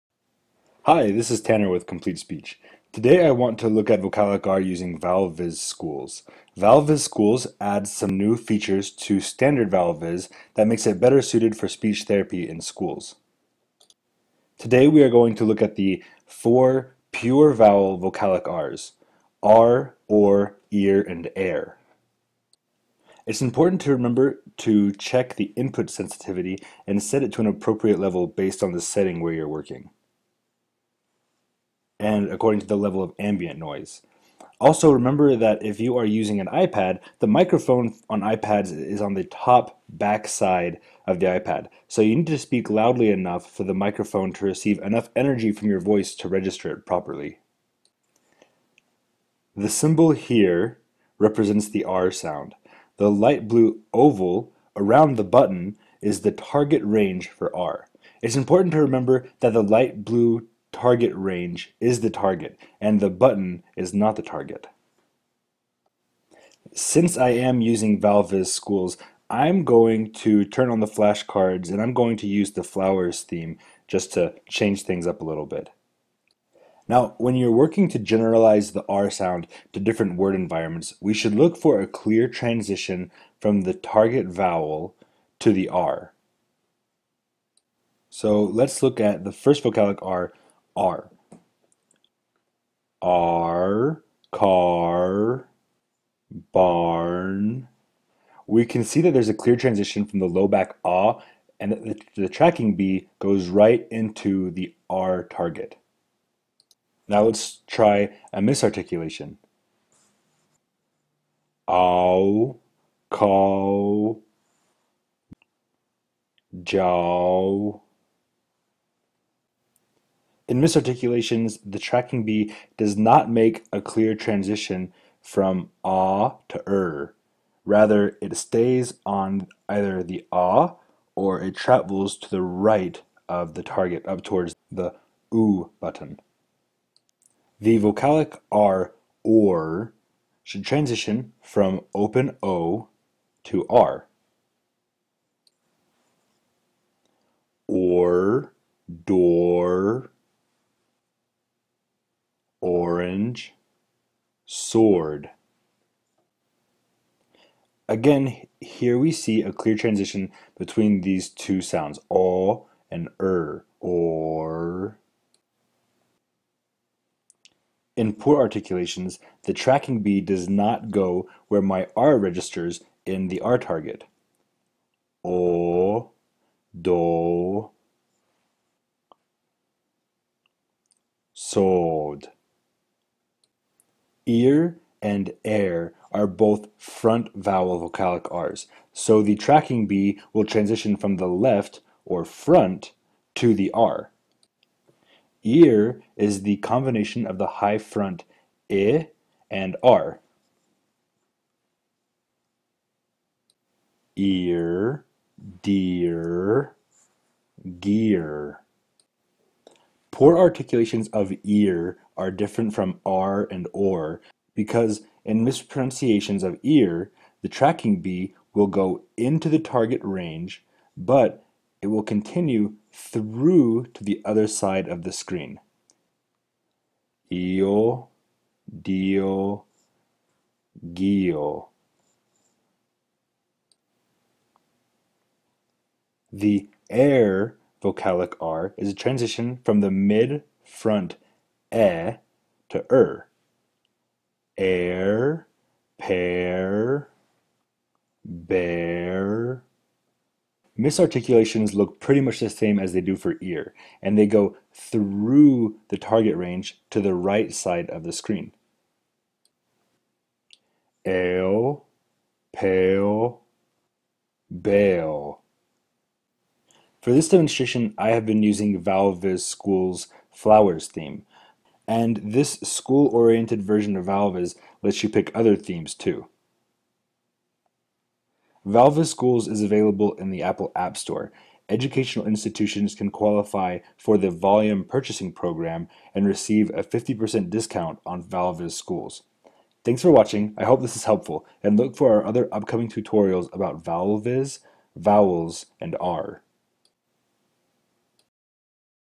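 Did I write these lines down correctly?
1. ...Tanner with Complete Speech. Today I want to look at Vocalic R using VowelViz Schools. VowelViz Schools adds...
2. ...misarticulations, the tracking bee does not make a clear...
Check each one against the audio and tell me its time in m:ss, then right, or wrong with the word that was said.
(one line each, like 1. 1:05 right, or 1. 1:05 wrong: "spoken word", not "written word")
1. 0:01 right
2. 2:00 right.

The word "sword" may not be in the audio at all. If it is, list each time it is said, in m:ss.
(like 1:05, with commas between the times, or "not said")
2:34, 3:01.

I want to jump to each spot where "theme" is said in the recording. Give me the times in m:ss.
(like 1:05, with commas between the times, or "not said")
1:13, 4:30, 4:35.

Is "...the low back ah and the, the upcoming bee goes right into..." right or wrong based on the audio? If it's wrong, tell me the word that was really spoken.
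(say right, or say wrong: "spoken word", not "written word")
wrong: "tracking", not "upcoming".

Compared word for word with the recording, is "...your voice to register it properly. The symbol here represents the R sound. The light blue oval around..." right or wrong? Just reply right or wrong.
right.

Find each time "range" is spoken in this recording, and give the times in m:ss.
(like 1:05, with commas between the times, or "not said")
0:56, 1:01, 3:40, 4:16.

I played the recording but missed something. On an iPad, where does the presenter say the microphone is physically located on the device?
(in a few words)
Top back side.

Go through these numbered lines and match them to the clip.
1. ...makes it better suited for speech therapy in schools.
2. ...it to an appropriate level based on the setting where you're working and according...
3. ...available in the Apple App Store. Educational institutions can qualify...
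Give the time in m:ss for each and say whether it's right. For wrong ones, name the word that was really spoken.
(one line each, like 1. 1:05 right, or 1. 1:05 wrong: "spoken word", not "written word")
1. 0:10 right
2. 0:27 right
3. 4:39 right.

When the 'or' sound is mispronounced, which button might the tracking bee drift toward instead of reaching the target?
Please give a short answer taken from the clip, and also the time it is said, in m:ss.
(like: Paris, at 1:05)
oo button, at 2:15.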